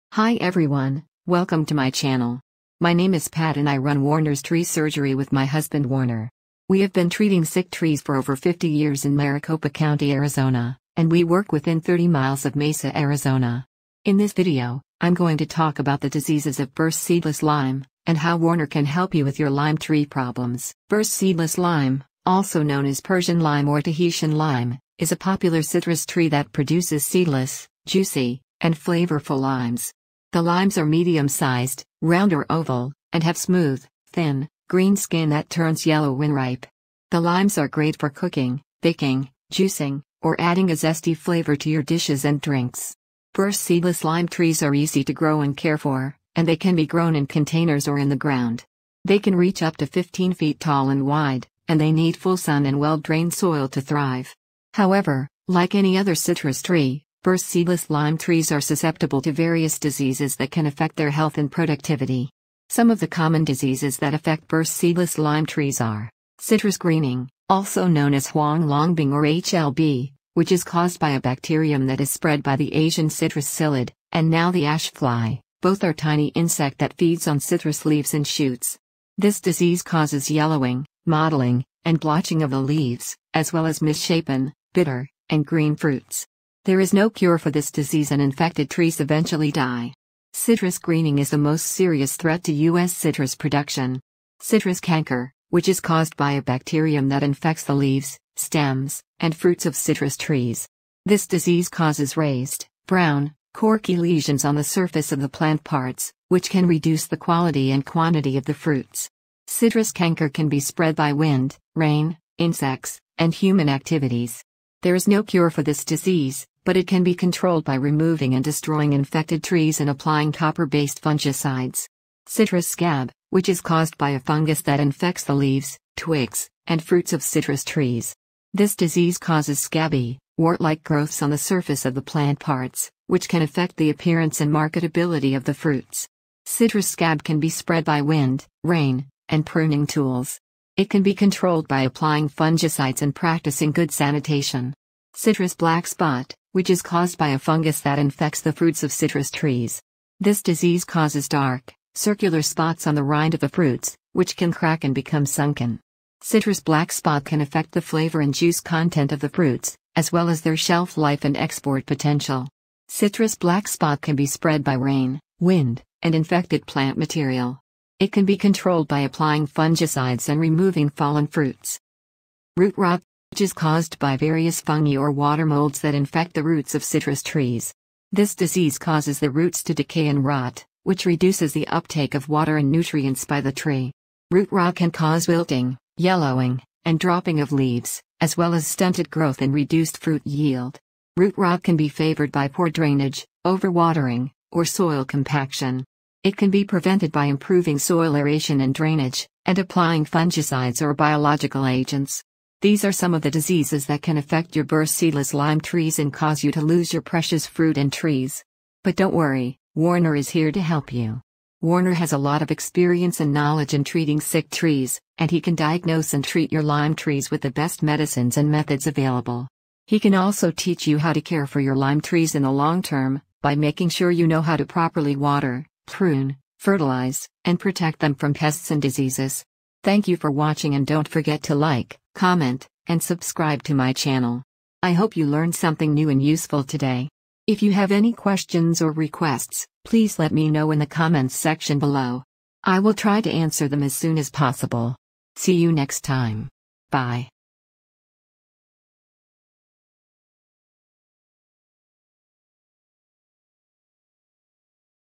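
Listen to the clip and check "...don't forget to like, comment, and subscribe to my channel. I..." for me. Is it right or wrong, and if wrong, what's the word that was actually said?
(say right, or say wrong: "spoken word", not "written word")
right.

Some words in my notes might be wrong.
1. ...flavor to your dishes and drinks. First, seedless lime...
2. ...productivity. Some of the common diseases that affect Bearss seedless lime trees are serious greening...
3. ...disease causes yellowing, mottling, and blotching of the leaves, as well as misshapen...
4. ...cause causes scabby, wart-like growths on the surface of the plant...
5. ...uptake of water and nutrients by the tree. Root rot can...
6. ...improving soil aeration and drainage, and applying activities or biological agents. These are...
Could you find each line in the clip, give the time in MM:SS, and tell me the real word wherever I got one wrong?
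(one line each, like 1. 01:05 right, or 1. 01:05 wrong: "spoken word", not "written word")
1. 00:41 right
2. 01:01 wrong: "citrus", not "serious"
3. 01:19 right
4. 02:08 wrong: "disease", not "cause"
5. 03:01 right
6. 03:17 wrong: "fungicides", not "activities".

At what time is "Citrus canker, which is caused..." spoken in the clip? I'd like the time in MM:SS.
01:34.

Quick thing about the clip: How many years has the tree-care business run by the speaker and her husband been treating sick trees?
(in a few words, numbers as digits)
Over 50.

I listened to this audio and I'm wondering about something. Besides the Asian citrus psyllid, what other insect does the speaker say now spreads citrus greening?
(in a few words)
Ash fly.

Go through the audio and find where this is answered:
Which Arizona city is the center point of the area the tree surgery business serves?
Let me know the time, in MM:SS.
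00:12.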